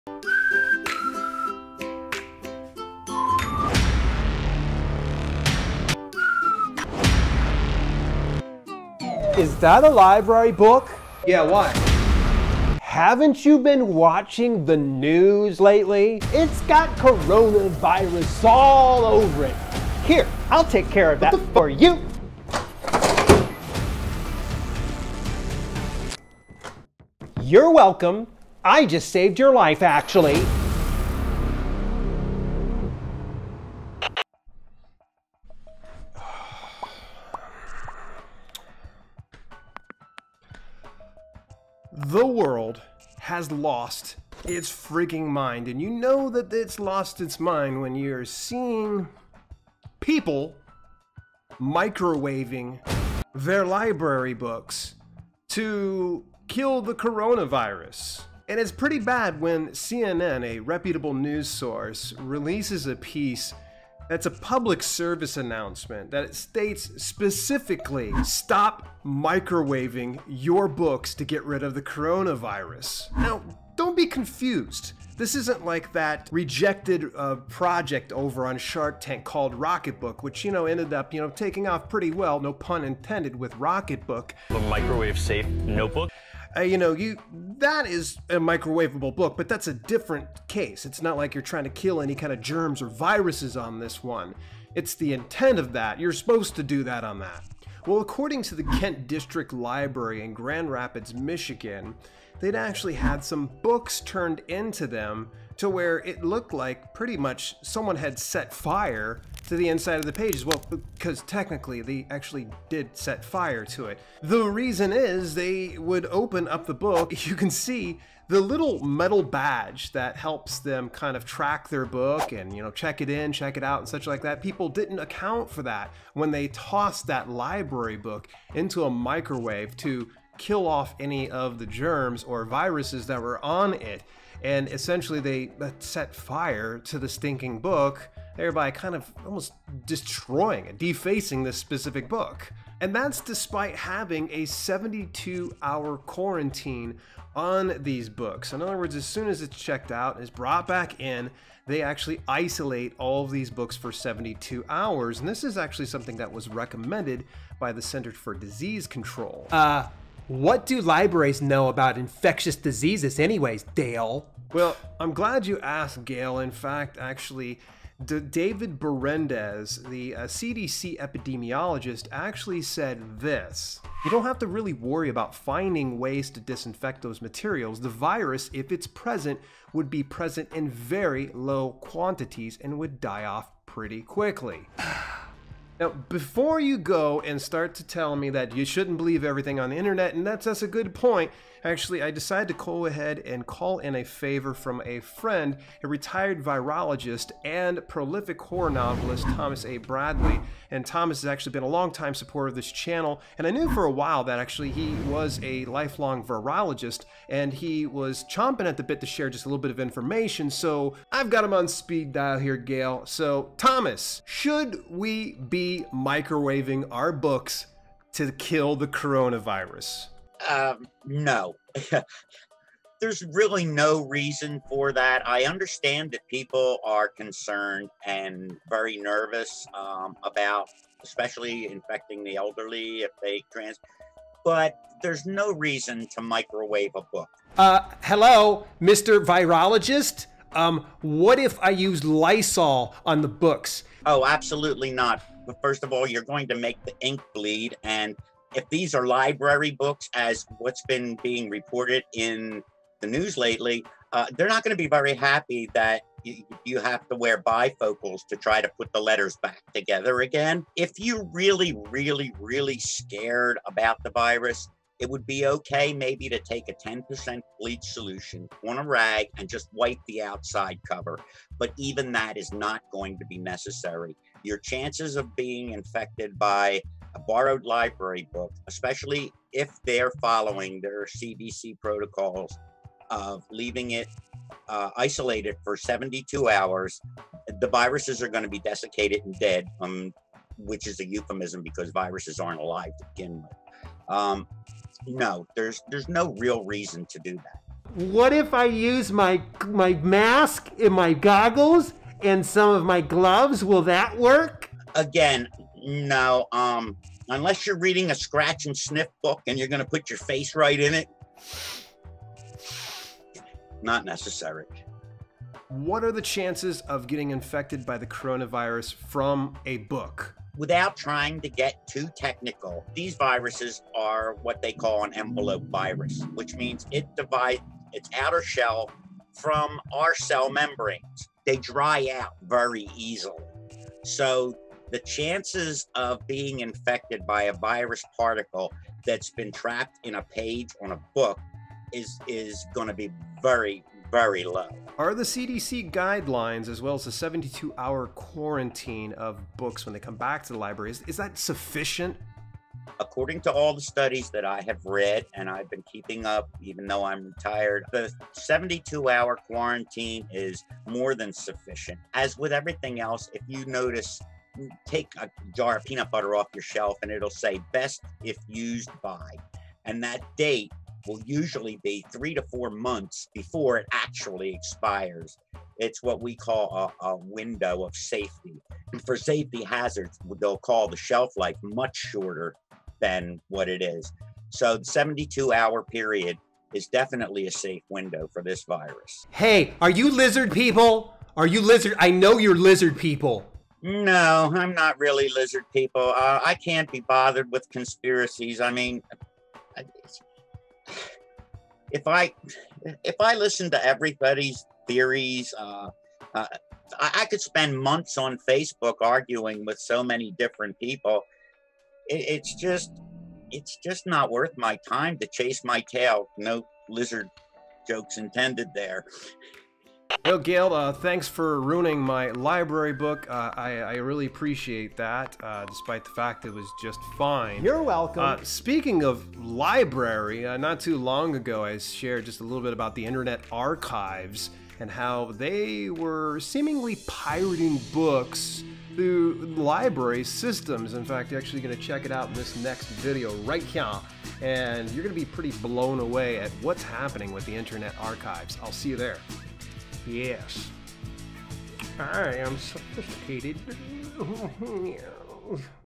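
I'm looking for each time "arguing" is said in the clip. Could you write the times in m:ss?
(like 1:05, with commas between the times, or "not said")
6:49.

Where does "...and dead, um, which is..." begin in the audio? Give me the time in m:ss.
4:49.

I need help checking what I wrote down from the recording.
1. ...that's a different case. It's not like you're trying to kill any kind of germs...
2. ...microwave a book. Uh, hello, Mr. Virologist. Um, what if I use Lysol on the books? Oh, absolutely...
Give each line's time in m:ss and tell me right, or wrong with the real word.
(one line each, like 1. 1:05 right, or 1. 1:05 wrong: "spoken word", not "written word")
1. 1:29 right
2. 3:56 right.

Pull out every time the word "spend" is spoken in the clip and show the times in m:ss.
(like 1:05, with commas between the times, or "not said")
6:47.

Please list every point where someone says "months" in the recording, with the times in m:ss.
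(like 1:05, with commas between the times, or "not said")
6:12, 6:47.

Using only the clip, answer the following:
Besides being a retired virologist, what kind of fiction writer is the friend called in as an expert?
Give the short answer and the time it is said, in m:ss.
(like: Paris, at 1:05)
horror novelist, at 3:18.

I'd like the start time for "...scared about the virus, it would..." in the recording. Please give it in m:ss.
4:22.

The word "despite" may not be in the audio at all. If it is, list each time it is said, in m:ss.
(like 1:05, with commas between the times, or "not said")
2:23, 7:05.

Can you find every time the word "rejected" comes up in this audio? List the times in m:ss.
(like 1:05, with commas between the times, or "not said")
1:16.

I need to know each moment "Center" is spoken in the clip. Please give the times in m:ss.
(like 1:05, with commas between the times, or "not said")
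2:37.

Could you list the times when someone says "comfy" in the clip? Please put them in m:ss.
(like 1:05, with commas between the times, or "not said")
not said.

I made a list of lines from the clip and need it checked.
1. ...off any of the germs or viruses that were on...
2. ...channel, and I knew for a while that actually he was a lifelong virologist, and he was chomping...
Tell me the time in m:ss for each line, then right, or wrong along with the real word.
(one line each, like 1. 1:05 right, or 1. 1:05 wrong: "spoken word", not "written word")
1. 2:10 right
2. 3:22 right.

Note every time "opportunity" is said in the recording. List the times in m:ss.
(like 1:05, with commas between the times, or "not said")
not said.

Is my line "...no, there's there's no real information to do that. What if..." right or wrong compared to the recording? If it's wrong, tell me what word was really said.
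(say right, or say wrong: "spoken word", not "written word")
wrong: "reason", not "information".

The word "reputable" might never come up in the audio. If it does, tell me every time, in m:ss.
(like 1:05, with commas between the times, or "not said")
1:00.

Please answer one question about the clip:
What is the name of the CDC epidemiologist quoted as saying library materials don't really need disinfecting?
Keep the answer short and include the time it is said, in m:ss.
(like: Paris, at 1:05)
David Berendes, at 2:48.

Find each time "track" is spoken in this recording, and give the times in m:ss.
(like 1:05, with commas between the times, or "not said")
2:01.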